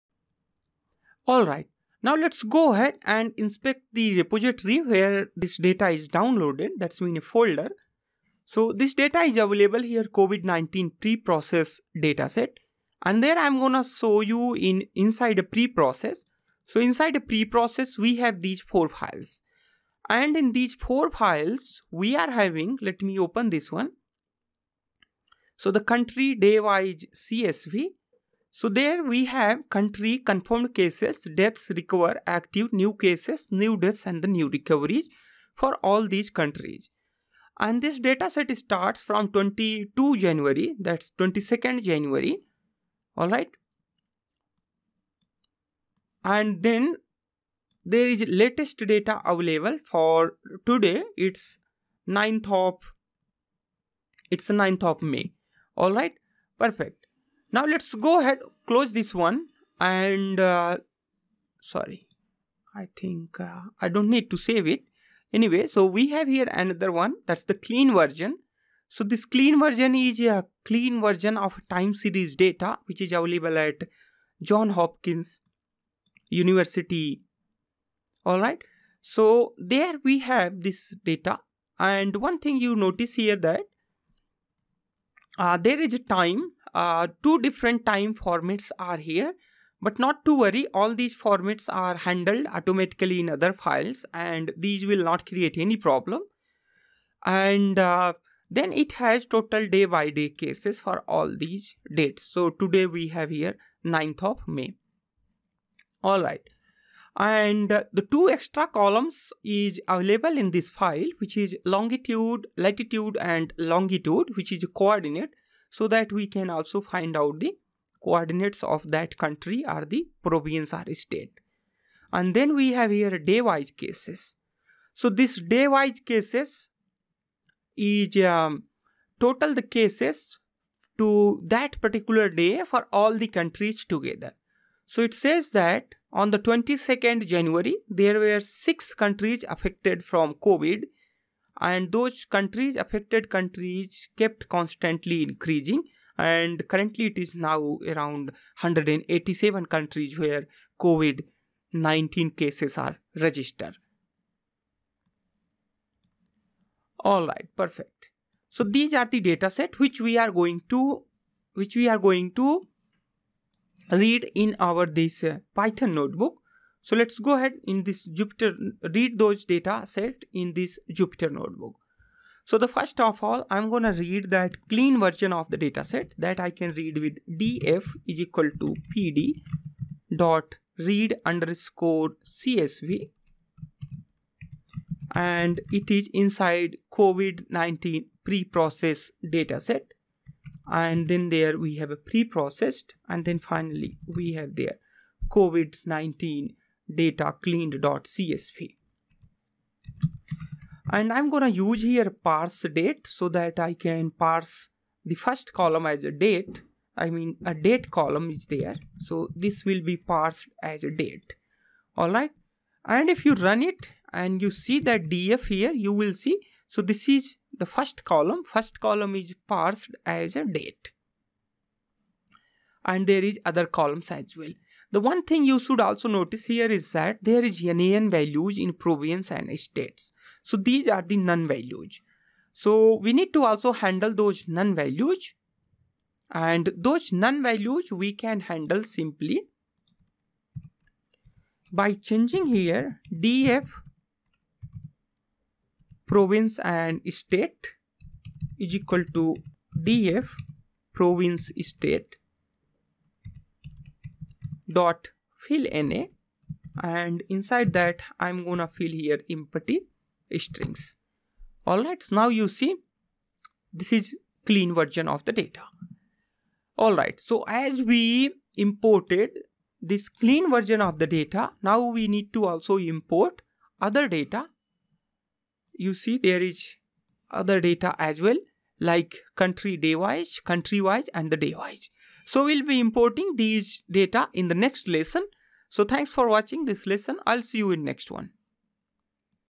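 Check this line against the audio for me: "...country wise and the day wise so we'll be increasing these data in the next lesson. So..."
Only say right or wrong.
wrong.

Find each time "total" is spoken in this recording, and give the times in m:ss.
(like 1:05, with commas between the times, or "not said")
1:39, 2:09.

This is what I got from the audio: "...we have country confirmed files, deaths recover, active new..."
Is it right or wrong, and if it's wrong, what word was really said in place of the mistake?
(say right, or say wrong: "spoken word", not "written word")
wrong: "cases", not "files".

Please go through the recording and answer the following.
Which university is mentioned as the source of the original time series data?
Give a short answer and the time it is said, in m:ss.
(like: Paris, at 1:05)
John Hopkins University, at 1:14.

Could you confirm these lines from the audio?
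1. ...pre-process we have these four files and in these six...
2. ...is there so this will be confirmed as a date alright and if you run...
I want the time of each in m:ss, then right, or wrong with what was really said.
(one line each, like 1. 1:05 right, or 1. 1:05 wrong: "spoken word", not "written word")
1. 0:17 wrong: "four", not "six"
2. 3:28 wrong: "parsed", not "confirmed".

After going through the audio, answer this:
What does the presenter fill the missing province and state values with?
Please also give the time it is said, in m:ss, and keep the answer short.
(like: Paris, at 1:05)
empty strings, at 4:19.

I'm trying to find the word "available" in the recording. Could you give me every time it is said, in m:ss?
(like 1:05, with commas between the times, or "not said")
0:09, 0:49, 1:13, 1:49.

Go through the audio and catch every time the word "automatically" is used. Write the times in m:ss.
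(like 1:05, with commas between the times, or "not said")
1:32.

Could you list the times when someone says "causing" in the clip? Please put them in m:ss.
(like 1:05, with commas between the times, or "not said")
not said.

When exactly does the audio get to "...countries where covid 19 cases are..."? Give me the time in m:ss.
2:29.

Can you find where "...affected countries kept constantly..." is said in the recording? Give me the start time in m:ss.
2:22.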